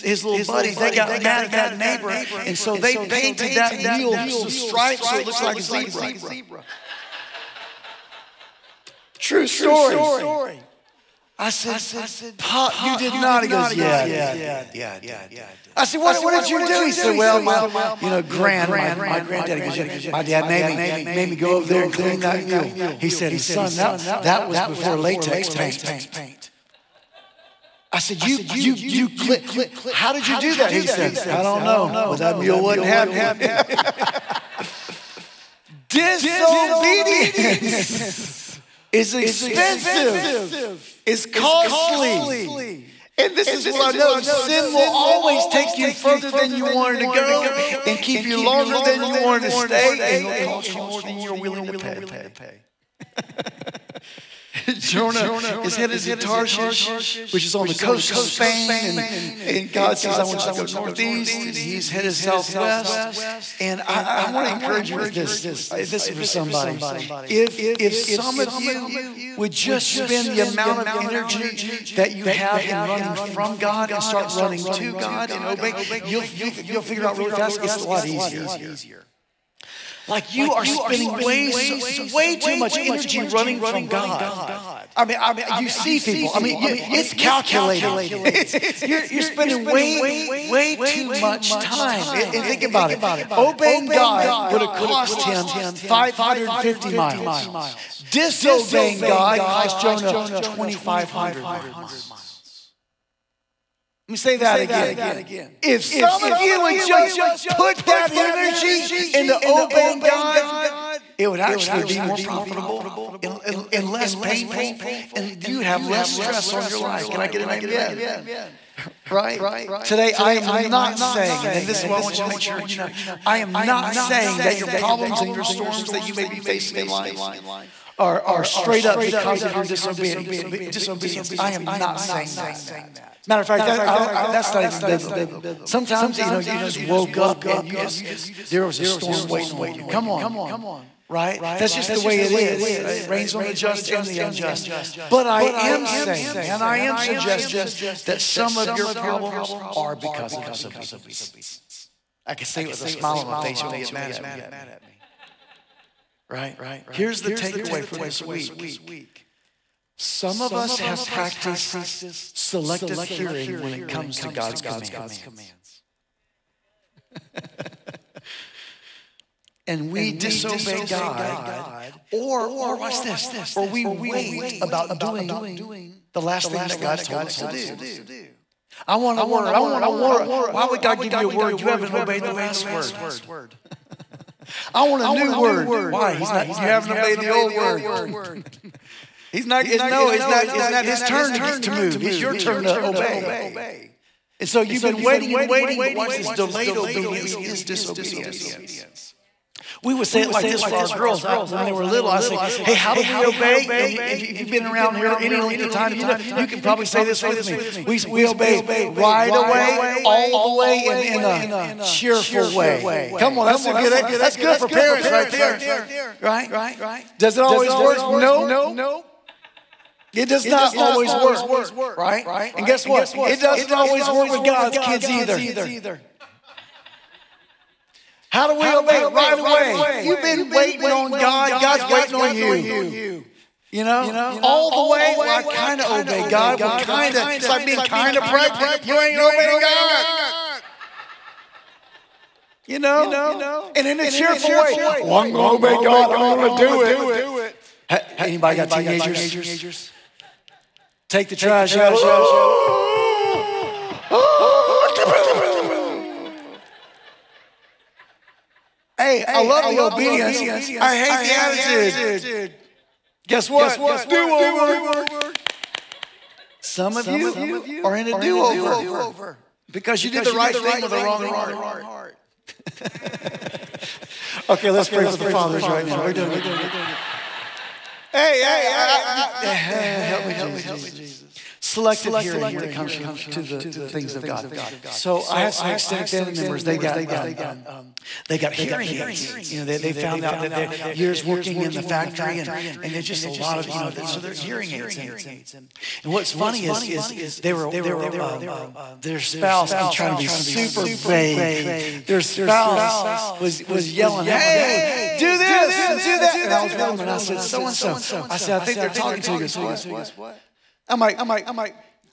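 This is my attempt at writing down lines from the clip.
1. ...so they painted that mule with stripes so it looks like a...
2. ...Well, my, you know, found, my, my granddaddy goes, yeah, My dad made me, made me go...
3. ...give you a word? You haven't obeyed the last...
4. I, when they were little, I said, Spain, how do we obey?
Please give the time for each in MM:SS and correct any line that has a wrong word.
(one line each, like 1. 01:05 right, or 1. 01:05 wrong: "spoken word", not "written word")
1. 00:02 right
2. 00:17 wrong: "grand", not "found"
3. 03:01 right
4. 03:21 wrong: "Hey", not "Spain".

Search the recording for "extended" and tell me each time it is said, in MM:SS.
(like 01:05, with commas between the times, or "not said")
04:45.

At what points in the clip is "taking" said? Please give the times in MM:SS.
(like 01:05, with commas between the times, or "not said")
not said.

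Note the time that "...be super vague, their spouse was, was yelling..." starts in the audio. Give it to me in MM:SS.
05:00.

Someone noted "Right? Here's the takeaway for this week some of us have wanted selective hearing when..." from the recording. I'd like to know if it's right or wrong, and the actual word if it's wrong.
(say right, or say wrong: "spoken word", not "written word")
wrong: "practiced", not "wanted".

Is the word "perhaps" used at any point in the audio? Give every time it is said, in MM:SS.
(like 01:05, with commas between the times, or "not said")
not said.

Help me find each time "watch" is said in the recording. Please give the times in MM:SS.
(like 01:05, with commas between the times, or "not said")
02:52, 03:15.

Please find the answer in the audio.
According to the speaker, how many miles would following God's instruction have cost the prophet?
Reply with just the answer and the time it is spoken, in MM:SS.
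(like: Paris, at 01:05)
550 miles, at 01:35.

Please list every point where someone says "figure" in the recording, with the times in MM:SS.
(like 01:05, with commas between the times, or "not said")
01:16.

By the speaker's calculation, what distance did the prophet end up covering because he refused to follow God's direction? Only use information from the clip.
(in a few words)
2,500 miles.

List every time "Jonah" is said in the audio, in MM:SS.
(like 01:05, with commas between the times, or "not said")
00:54, 01:39.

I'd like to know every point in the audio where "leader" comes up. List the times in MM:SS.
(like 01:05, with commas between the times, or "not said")
not said.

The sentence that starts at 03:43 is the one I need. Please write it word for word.
It doesn't always work with God's kids either.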